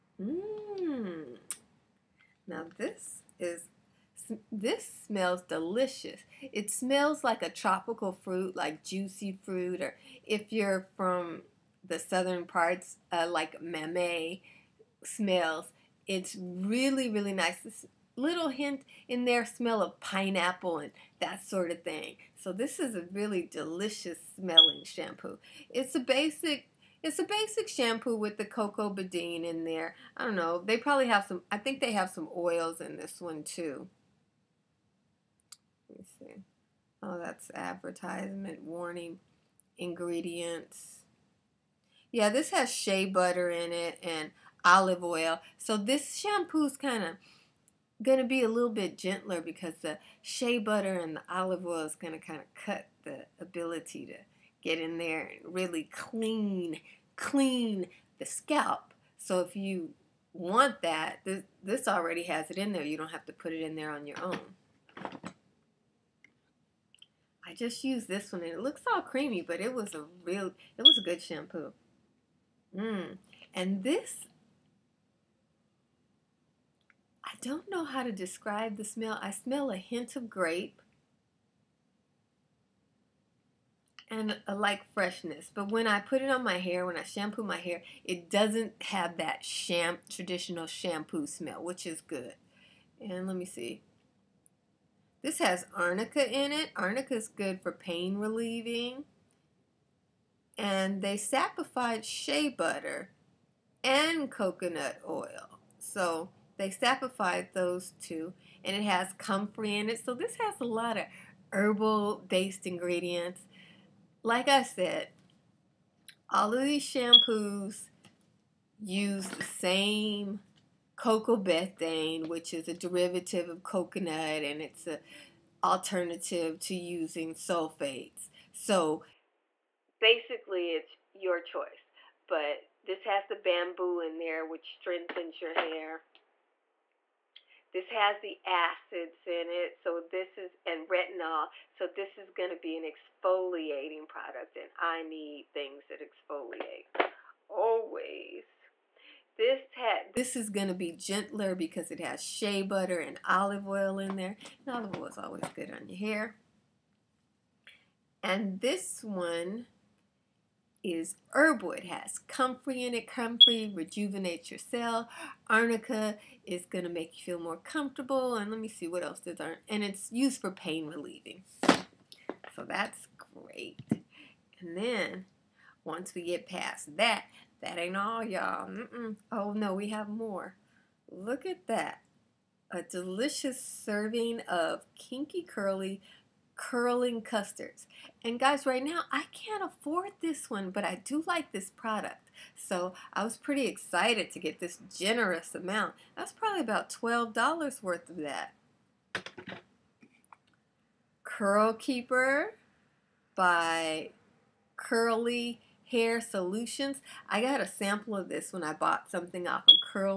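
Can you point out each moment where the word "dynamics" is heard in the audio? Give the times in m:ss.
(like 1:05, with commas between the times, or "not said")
not said.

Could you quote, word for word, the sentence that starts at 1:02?
You don't have to put it in there on your own.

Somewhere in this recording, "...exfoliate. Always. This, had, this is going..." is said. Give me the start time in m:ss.
2:26.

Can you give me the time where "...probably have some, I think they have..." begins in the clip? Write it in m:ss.
0:30.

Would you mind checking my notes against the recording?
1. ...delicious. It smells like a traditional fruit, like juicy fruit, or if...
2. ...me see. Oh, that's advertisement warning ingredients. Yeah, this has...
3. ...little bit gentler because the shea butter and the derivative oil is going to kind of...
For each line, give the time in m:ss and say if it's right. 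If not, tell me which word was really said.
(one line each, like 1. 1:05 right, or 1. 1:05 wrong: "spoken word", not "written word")
1. 0:05 wrong: "tropical", not "traditional"
2. 0:35 right
3. 0:48 wrong: "olive", not "derivative".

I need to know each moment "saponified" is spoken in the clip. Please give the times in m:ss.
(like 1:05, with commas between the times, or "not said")
1:41, 1:46.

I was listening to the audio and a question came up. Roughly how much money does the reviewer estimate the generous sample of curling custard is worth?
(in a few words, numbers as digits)
$12.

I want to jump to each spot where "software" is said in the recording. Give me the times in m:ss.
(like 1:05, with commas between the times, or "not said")
not said.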